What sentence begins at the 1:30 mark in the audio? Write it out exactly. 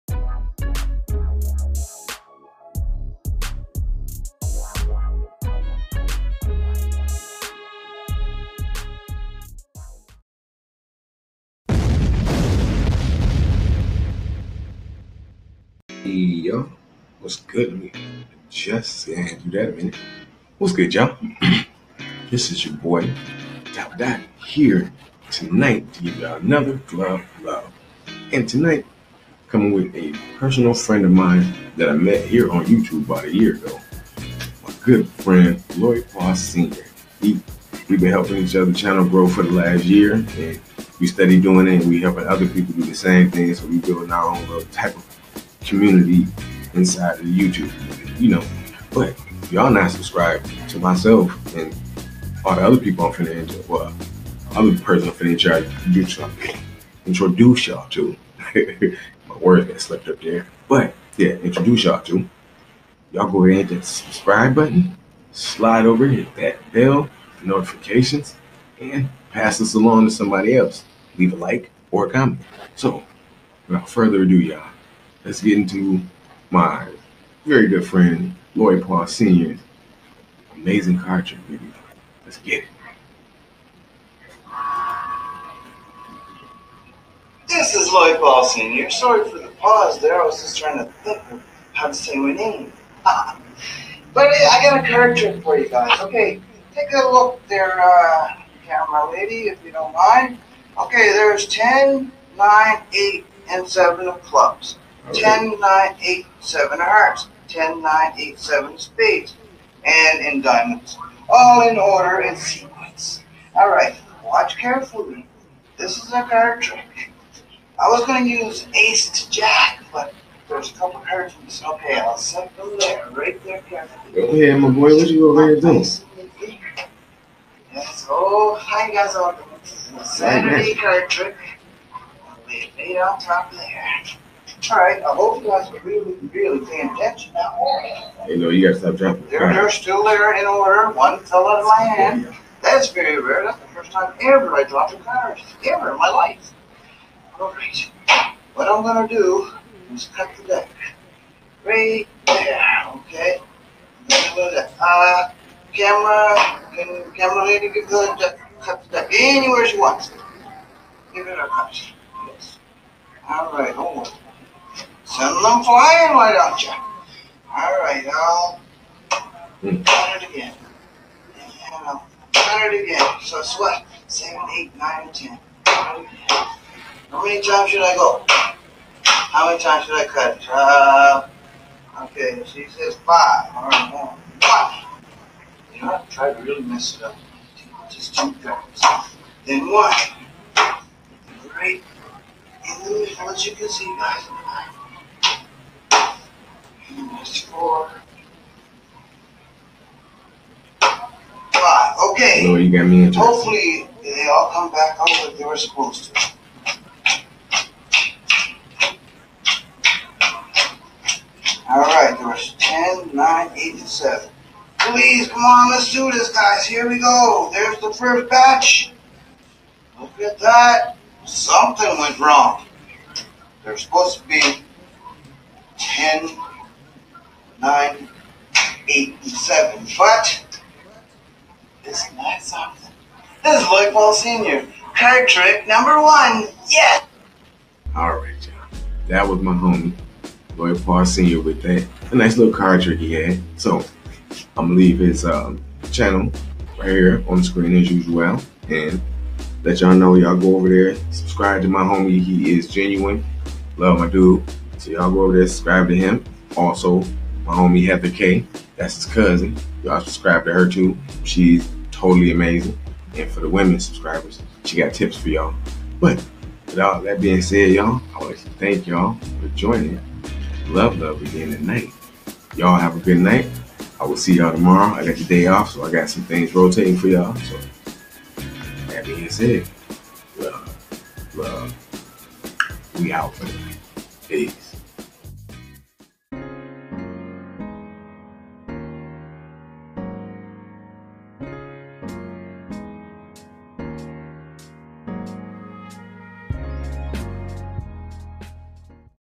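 I was just trying to think of how to say my name.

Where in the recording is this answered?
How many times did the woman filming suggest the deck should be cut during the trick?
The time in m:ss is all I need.
3:02.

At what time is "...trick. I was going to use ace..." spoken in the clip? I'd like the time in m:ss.
1:56.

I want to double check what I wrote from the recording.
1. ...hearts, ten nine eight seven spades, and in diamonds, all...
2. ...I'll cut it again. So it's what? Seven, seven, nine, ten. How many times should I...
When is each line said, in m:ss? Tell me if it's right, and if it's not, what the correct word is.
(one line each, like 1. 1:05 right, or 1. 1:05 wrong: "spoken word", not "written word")
1. 1:46 right
2. 2:51 wrong: "eight", not "seven".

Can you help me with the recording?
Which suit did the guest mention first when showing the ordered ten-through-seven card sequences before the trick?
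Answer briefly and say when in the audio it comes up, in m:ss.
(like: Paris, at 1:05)
clubs, at 1:43.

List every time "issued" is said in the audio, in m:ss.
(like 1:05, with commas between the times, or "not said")
not said.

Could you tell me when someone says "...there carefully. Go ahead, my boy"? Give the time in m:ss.
2:03.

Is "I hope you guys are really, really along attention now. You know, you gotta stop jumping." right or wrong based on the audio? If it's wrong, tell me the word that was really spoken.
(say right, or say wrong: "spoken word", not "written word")
wrong: "paying", not "along".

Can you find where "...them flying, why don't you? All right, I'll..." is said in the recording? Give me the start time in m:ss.
2:45.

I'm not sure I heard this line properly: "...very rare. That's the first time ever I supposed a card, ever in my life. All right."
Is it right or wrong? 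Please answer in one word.
wrong.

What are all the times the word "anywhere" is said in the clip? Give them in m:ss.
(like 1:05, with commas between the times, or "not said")
2:39.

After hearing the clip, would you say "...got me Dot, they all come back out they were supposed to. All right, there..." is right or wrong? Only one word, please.
wrong.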